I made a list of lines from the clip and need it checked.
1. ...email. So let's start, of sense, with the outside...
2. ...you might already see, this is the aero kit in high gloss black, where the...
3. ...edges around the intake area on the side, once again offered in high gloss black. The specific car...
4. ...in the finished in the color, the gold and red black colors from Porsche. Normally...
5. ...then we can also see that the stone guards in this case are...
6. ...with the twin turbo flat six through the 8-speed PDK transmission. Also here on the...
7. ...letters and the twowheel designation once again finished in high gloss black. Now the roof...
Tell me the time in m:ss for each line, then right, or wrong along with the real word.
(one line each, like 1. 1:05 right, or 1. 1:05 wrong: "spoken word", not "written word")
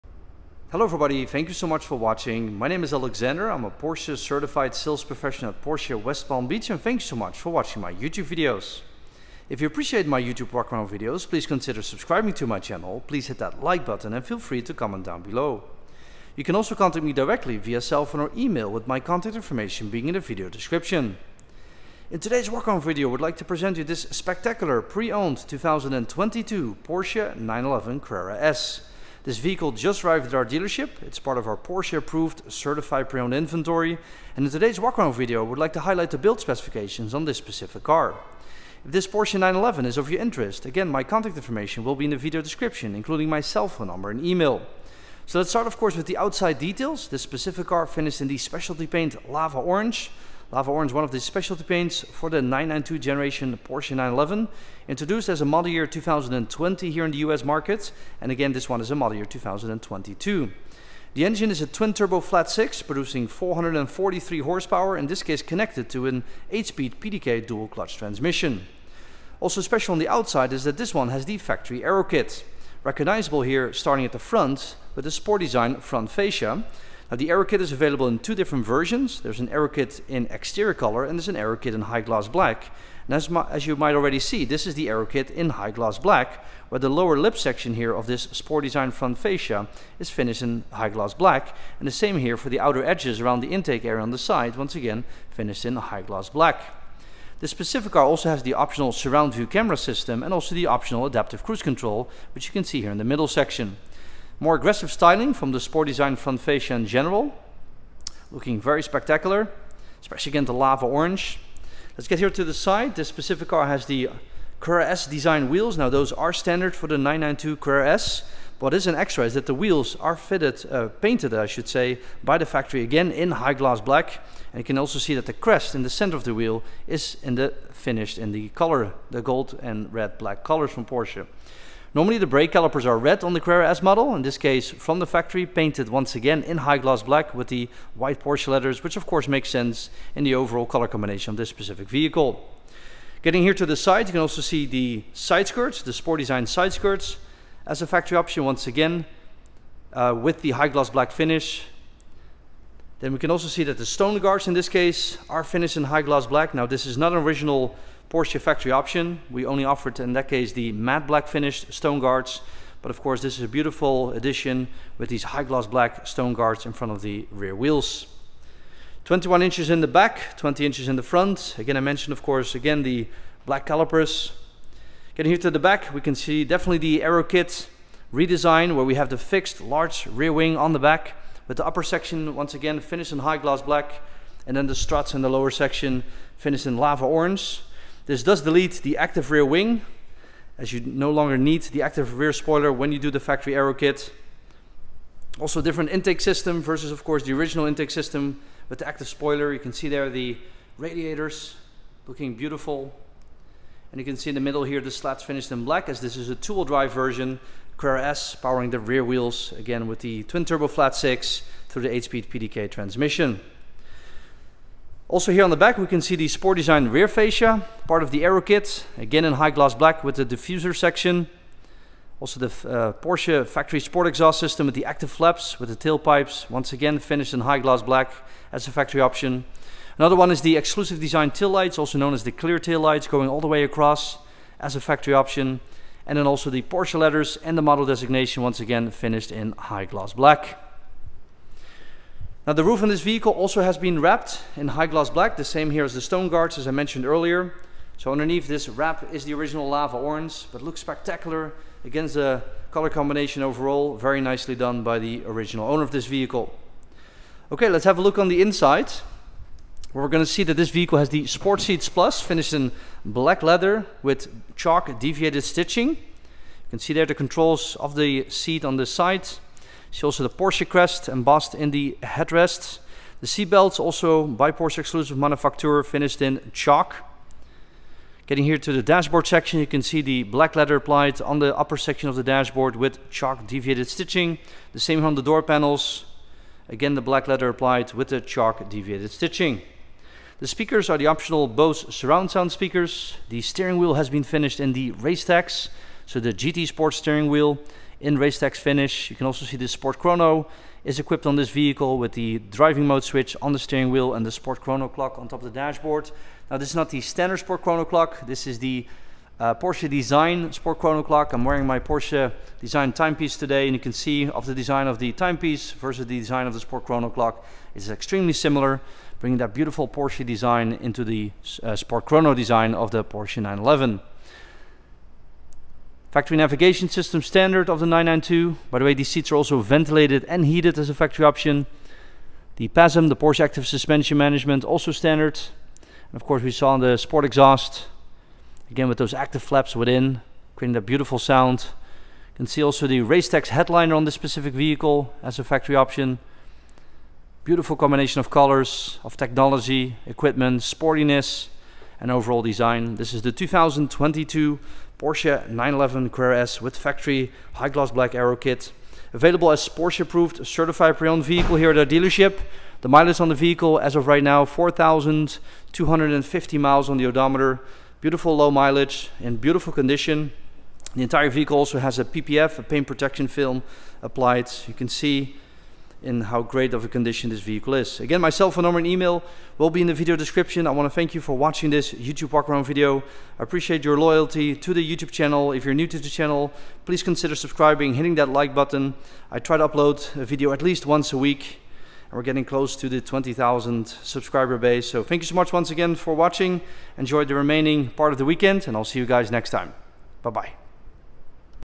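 1. 0:44 wrong: "course", not "sense"
2. 1:23 right
3. 1:32 wrong: "finished", not "offered"
4. 2:07 right
5. 2:33 right
6. 3:29 right
7. 3:56 wrong: "model", not "twowheel".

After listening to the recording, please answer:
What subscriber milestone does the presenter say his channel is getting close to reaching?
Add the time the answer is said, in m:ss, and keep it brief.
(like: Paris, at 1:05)
20,000, at 6:32.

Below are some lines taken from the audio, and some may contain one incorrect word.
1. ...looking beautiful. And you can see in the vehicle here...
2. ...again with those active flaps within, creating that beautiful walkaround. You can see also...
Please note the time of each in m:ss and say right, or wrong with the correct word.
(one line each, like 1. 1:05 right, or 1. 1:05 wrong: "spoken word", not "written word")
1. 3:22 wrong: "middle", not "vehicle"
2. 5:38 wrong: "sound", not "walkaround".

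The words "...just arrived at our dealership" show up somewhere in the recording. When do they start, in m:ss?
0:29.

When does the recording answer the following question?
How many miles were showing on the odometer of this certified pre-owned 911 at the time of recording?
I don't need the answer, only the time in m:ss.
6:04.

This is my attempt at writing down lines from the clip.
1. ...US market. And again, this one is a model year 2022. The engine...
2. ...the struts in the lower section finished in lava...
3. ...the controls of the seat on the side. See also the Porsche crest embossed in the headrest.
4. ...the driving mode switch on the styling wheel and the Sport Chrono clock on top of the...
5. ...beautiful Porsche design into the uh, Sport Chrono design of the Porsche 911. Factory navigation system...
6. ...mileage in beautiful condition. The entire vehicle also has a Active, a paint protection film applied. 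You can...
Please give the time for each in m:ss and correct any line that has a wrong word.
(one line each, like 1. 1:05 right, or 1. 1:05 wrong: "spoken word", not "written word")
1. 0:57 right
2. 3:04 right
3. 4:27 right
4. 5:02 wrong: "steering", not "styling"
5. 5:19 right
6. 6:08 wrong: "PPF", not "Active".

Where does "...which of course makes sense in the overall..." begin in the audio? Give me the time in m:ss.
2:18.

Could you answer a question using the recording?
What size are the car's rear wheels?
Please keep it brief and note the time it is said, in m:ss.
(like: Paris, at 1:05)
21 inches, at 2:49.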